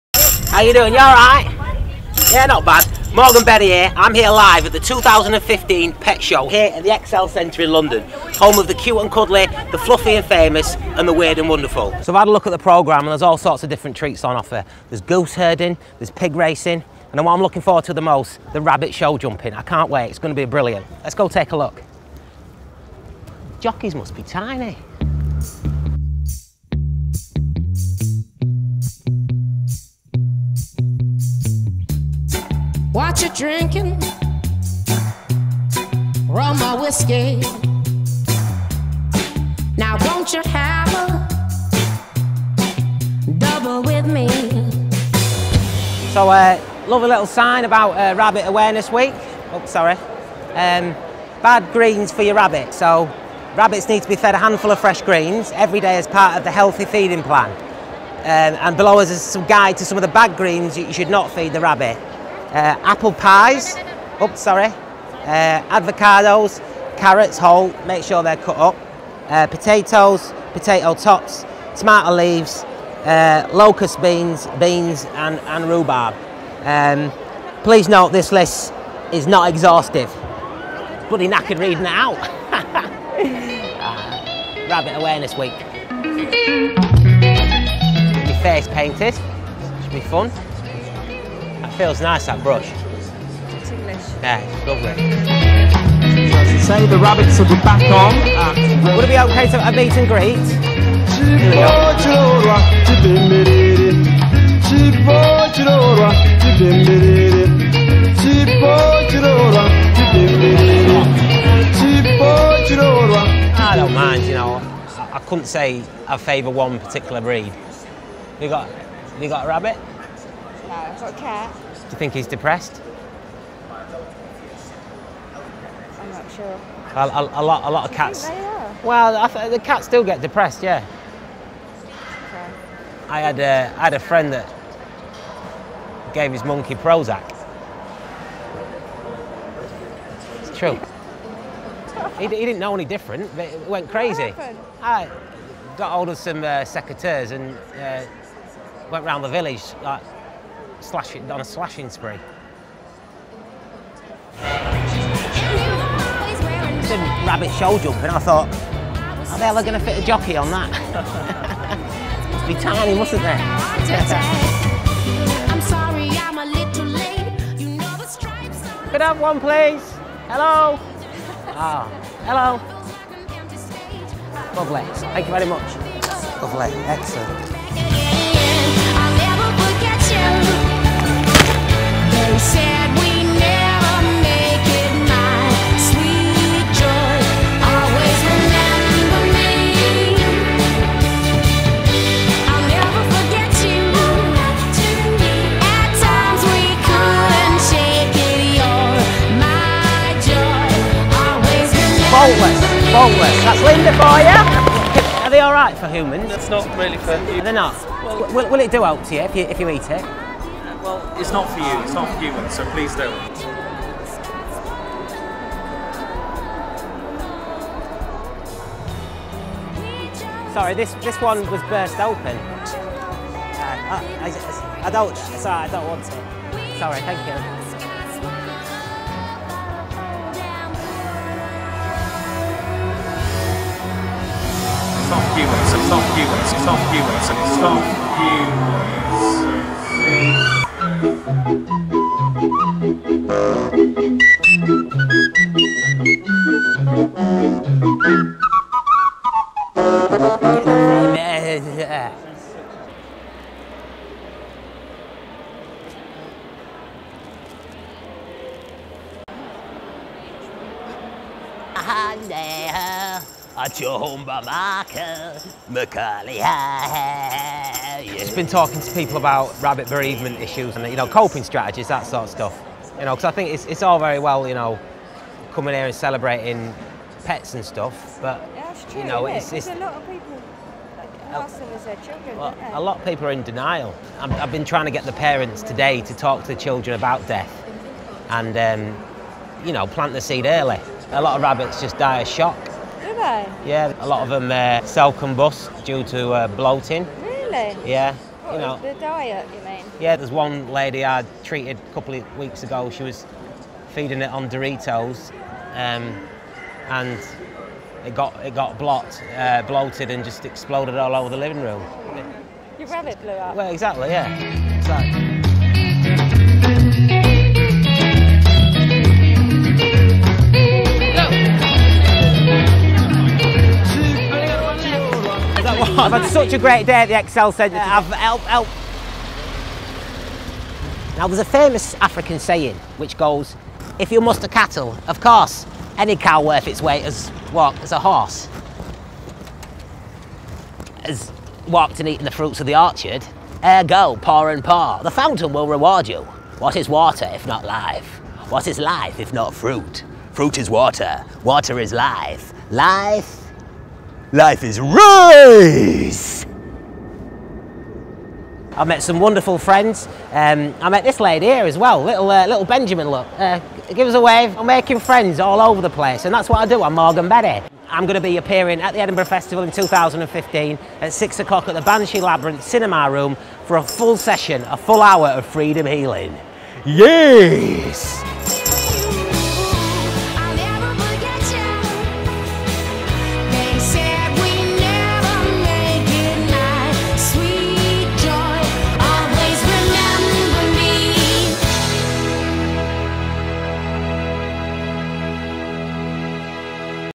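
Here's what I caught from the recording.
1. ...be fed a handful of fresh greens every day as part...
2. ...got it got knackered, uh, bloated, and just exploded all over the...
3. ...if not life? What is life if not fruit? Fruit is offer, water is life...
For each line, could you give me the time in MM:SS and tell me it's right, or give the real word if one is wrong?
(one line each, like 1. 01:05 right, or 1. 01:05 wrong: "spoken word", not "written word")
1. 00:54 right
2. 05:08 wrong: "blocked", not "knackered"
3. 05:47 wrong: "water", not "offer".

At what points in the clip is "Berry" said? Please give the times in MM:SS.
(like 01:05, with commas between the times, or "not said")
00:03, 06:07.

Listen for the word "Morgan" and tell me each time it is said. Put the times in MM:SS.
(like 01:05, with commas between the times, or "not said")
00:03, 06:06.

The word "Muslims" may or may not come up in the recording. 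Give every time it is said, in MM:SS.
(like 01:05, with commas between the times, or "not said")
not said.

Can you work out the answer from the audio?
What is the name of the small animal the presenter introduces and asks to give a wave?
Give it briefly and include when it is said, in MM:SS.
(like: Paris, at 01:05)
Benjamin, at 06:02.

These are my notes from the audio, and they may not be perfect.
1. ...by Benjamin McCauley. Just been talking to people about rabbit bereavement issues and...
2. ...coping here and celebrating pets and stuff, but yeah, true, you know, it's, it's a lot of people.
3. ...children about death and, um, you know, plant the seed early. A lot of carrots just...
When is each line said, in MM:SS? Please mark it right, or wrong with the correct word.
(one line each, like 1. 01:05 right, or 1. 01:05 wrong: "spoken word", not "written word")
1. 04:24 wrong: "Michael", not "Benjamin"
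2. 04:35 wrong: "coming", not "coping"
3. 04:46 wrong: "rabbits", not "carrots".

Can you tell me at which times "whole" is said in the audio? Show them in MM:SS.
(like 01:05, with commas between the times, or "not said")
01:07.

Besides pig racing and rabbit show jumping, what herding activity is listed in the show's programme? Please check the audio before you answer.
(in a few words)
Goose herding.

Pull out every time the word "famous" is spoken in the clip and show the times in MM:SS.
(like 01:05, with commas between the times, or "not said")
00:10, 05:31.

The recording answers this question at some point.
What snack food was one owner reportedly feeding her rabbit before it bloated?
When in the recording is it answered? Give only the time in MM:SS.
05:04.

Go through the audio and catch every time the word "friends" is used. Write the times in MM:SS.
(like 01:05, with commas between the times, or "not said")
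02:13, 05:59, 06:04.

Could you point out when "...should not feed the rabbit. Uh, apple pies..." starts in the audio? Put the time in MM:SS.
01:00.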